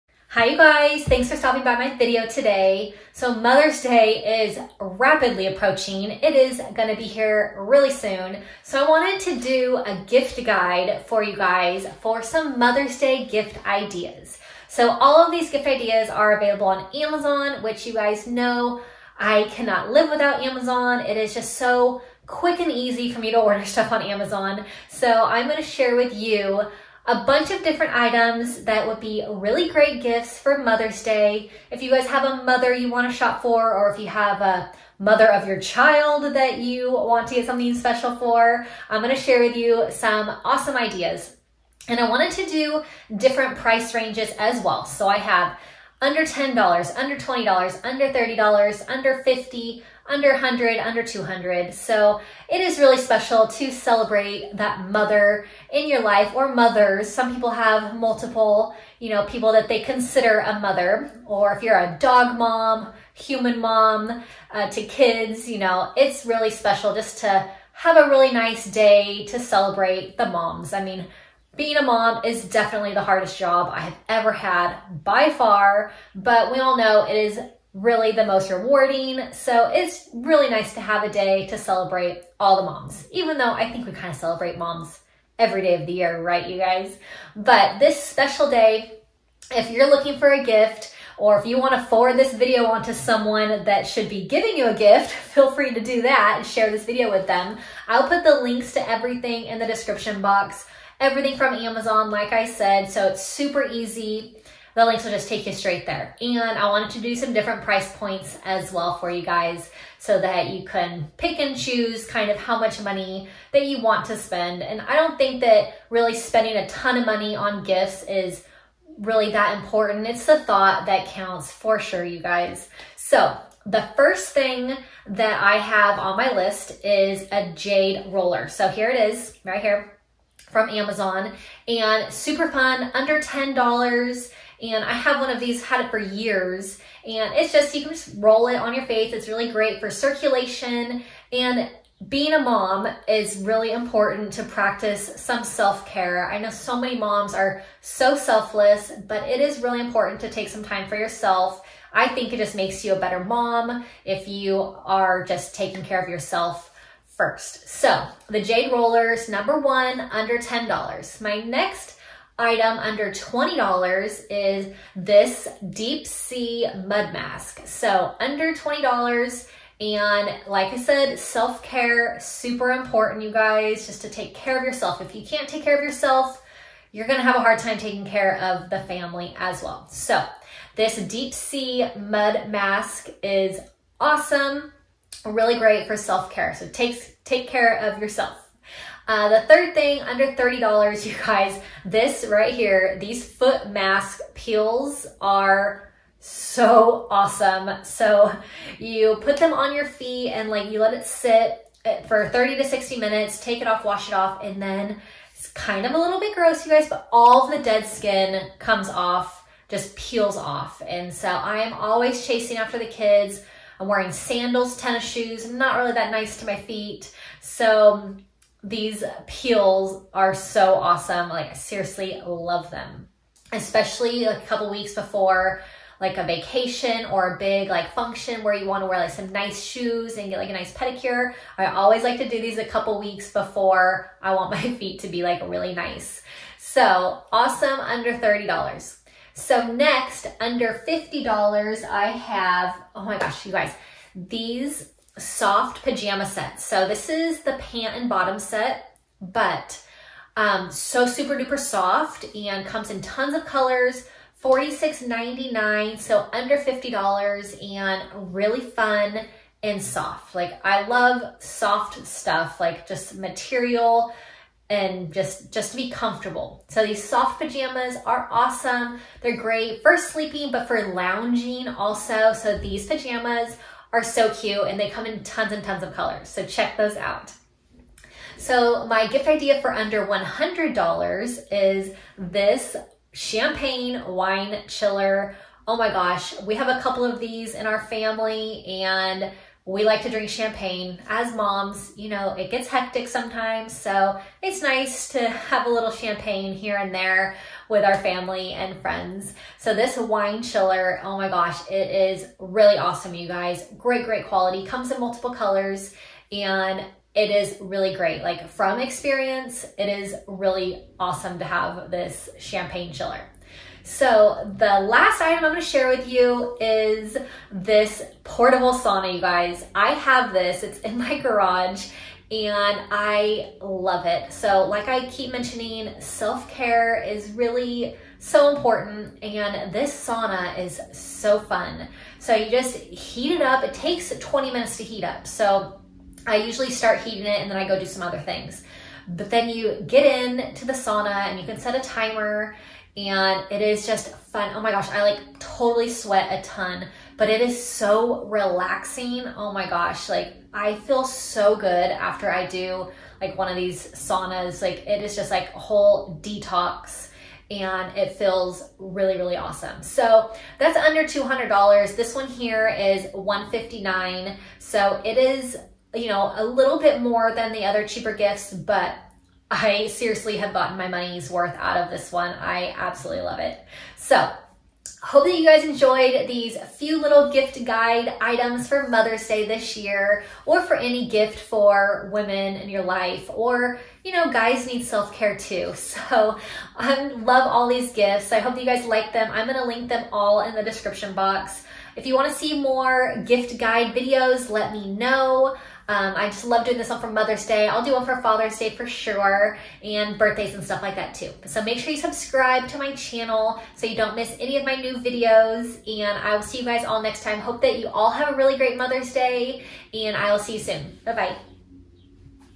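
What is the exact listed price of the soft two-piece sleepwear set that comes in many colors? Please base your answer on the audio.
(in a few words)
$46.99.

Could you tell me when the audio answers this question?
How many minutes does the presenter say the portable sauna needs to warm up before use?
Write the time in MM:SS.
05:34.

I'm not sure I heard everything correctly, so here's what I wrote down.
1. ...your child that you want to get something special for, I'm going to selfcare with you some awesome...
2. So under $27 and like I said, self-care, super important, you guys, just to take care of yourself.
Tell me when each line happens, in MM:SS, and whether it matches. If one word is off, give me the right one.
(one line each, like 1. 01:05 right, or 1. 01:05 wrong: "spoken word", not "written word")
1. 00:35 wrong: "share", not "selfcare"
2. 02:47 wrong: "20", not "27".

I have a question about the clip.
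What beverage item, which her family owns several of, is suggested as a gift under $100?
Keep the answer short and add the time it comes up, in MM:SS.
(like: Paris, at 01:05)
champagne wine chiller, at 04:43.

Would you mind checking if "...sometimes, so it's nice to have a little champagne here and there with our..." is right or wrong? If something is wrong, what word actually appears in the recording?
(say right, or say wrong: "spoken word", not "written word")
right.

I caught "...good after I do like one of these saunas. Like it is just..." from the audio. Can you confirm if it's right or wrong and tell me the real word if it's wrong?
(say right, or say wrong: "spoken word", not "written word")
right.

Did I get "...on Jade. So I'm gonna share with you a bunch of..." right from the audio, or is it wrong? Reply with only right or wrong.
wrong.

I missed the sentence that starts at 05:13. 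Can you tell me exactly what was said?
So the last item I'm gonna share with you is this portable sauna, you guys.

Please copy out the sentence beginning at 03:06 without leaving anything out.
So take, take care of yourself.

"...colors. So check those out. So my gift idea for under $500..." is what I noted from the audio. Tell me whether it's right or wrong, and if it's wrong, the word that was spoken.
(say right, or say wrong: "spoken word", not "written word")
wrong: "100", not "500".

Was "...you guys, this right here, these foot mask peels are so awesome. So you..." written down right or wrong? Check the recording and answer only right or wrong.
right.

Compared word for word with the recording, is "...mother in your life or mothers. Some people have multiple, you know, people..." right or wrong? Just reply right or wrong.
right.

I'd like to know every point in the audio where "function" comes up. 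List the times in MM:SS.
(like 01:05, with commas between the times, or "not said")
03:47.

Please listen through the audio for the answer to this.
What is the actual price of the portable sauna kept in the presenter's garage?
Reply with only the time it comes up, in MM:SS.
06:03.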